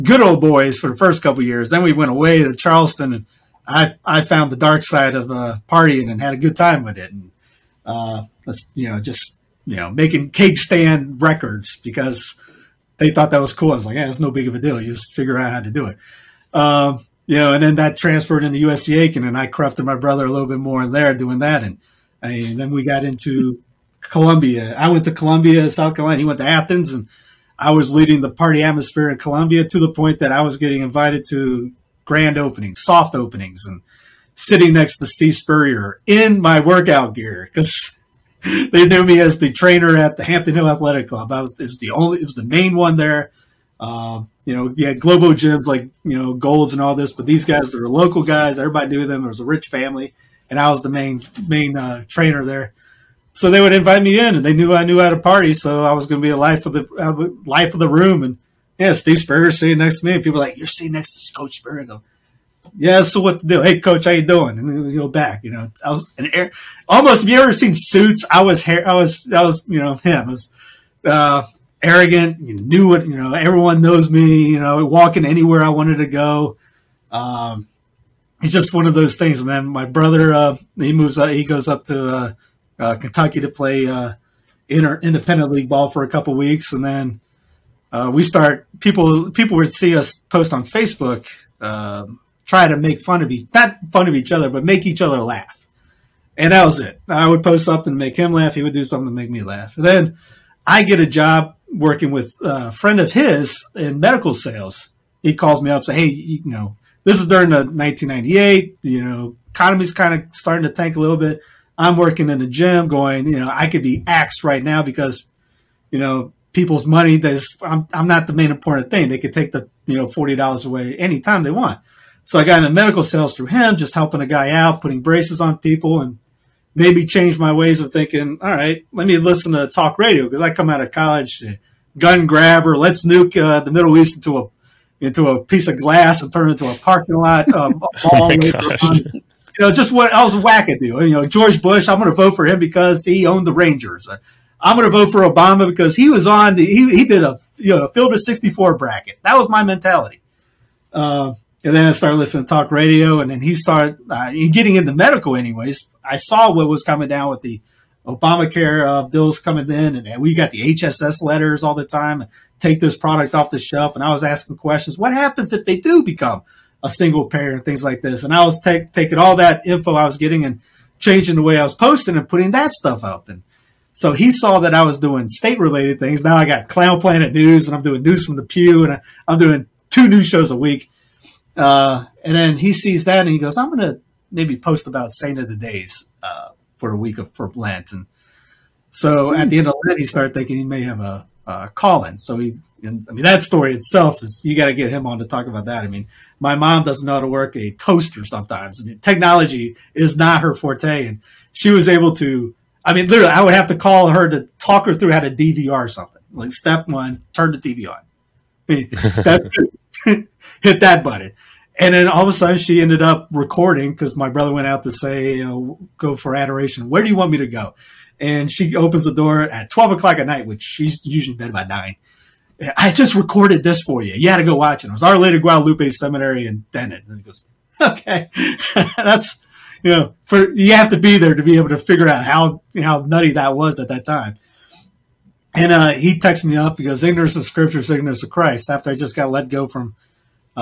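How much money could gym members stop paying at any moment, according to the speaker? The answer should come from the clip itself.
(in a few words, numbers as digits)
$40.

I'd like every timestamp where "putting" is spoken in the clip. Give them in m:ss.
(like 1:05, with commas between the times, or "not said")
2:04, 2:52.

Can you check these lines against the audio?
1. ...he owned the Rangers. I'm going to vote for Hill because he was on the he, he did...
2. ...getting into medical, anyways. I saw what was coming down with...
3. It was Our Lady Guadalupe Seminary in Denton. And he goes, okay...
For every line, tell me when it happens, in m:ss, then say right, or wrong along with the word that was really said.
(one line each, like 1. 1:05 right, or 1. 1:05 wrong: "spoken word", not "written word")
1. 2:23 wrong: "Obama", not "Hill"
2. 2:34 right
3. 3:44 right.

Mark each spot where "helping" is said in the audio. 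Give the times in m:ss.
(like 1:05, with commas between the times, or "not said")
2:03.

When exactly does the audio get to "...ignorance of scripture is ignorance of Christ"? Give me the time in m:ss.
3:57.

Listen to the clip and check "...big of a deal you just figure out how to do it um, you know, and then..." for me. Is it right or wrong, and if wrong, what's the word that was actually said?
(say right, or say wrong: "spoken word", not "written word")
right.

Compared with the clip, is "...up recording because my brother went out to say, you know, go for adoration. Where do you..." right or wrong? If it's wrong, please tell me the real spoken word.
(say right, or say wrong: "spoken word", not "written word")
right.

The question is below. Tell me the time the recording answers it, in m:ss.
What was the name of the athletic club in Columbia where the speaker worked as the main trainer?
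0:40.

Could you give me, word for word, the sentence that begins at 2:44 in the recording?
What happens if they do become a single parent, things like this?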